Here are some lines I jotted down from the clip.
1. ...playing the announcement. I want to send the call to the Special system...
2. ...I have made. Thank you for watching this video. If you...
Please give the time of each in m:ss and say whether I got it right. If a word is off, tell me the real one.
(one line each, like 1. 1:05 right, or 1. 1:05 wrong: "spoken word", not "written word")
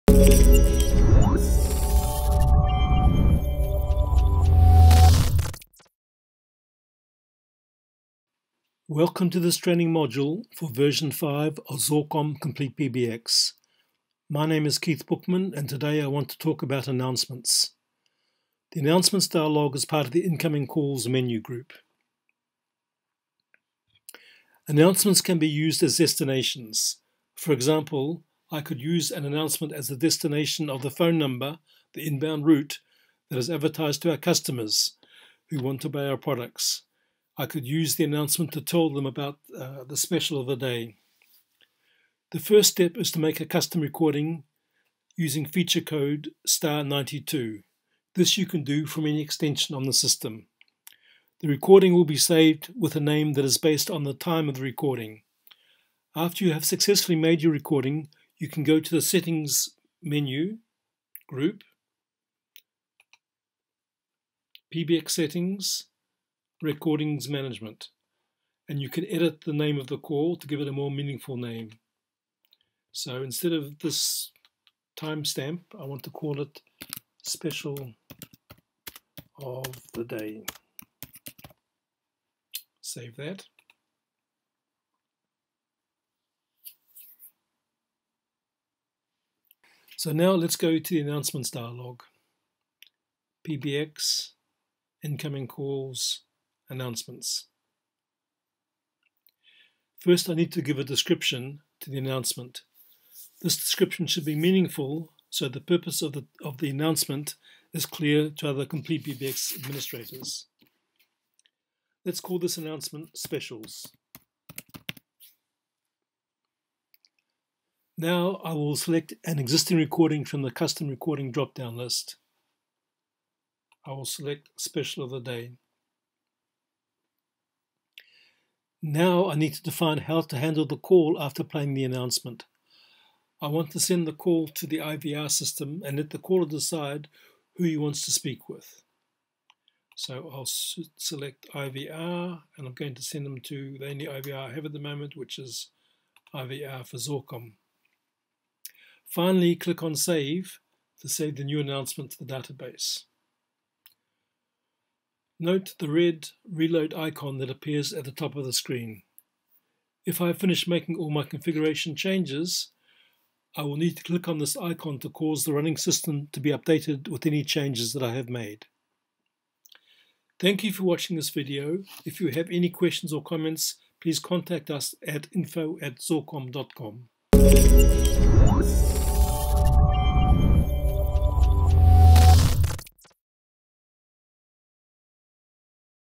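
1. 2:11 wrong: "IVR", not "Special"
2. 2:48 right.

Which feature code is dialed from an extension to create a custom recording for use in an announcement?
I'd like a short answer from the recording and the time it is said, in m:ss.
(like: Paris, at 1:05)
*92, at 0:46.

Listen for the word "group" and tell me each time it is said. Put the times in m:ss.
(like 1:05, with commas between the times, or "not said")
0:21, 1:01.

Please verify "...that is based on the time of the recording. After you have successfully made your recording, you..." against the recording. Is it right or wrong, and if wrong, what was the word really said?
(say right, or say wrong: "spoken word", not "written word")
right.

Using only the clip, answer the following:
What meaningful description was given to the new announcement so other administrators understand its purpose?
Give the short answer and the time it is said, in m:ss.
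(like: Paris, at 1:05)
Specials, at 1:53.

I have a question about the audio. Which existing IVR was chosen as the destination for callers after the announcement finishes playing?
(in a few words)
IVR for Xorcom.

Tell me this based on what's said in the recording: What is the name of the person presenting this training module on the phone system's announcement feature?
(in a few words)
Keith Bookman.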